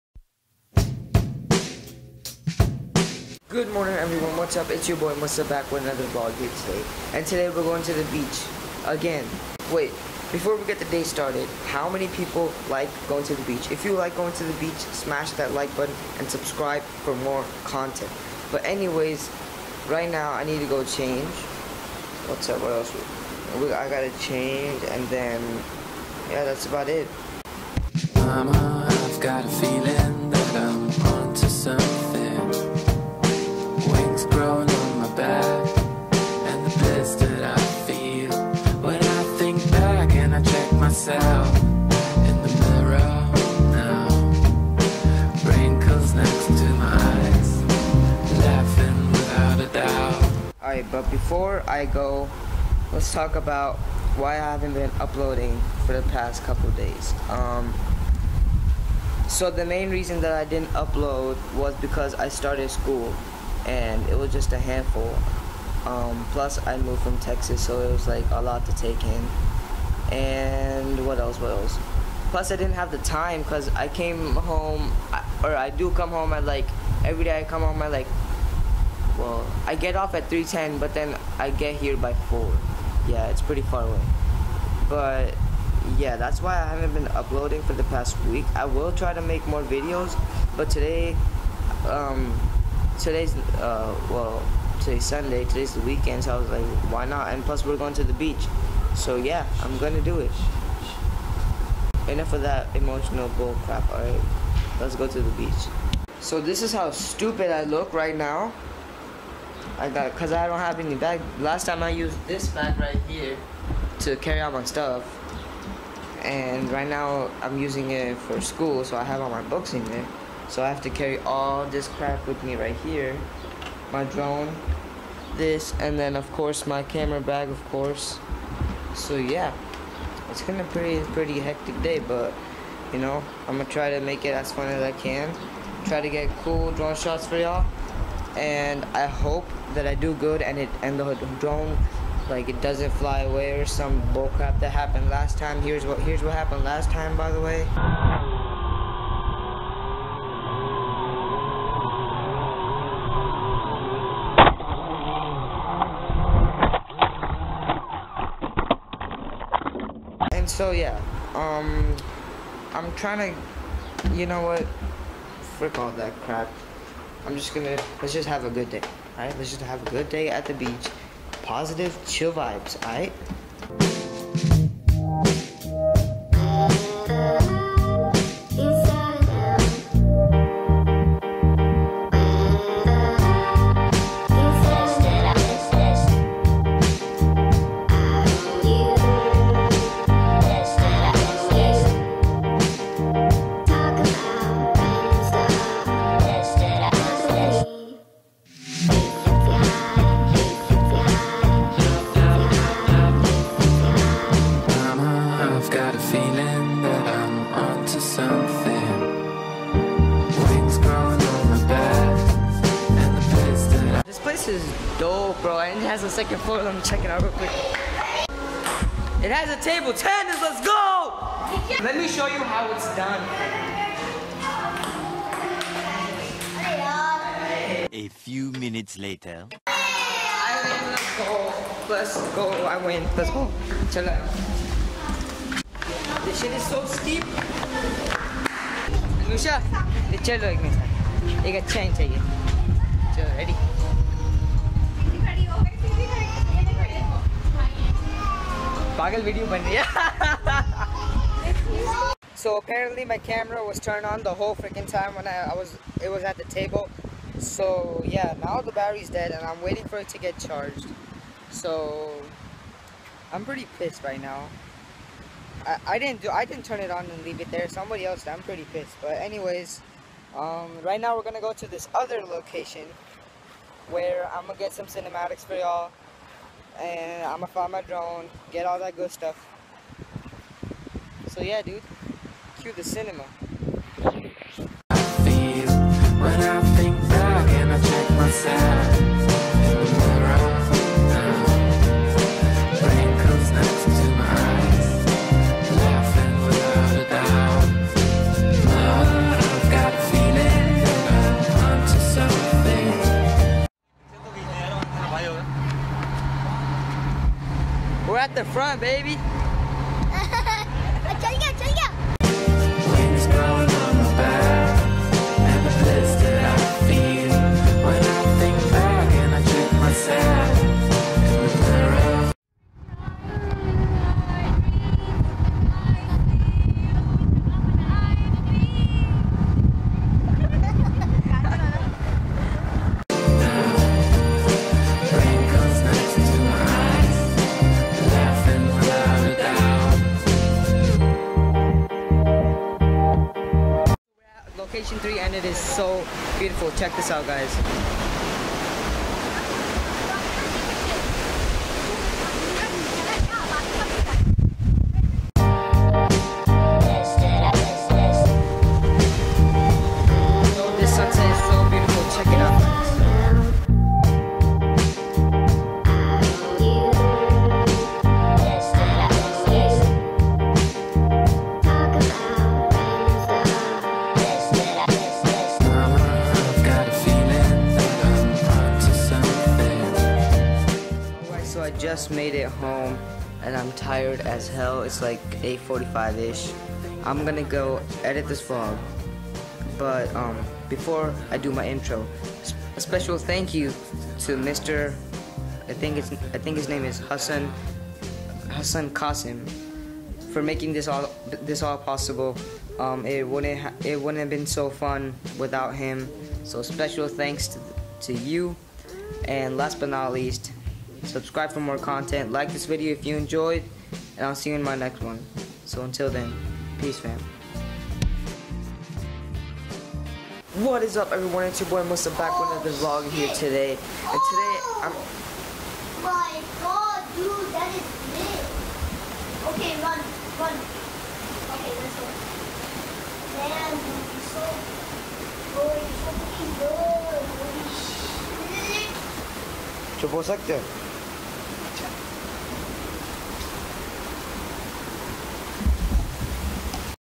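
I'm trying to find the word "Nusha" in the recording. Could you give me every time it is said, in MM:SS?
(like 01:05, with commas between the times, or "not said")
03:59.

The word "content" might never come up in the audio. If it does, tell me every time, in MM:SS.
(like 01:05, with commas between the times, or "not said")
00:17, 06:51.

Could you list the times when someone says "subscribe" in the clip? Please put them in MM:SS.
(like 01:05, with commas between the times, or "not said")
00:16, 06:51.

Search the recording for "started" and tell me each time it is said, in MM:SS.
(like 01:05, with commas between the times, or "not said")
00:11, 01:02.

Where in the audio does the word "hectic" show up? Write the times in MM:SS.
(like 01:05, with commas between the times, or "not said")
02:11.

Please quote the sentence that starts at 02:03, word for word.
My drone, this, and then of course my camera bag, of course.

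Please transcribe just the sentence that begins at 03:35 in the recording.
And it has a second floor.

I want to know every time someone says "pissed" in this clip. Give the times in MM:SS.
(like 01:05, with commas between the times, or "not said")
04:23, 04:28.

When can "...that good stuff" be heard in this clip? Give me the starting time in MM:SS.
04:38.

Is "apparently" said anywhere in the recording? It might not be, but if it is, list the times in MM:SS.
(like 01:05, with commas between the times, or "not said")
04:12.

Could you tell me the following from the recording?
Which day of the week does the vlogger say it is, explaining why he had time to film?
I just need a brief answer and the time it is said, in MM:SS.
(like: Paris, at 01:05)
Sunday, at 01:35.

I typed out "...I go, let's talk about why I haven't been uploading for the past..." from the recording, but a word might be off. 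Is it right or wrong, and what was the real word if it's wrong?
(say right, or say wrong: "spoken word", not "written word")
right.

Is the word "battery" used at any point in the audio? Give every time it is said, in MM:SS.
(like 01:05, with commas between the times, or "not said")
04:18.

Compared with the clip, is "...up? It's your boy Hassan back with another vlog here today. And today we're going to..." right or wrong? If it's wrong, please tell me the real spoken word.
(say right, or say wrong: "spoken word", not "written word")
wrong: "Musa", not "Hassan".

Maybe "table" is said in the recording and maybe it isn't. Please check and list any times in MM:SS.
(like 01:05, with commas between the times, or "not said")
03:39, 04:16.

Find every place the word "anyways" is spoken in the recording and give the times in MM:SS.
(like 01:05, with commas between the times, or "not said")
00:18, 04:29.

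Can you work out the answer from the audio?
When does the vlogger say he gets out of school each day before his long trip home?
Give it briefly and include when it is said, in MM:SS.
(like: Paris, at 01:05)
3:10, at 01:20.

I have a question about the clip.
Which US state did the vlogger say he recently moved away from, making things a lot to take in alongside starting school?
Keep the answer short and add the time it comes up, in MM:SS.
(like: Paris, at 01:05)
Texas, at 01:07.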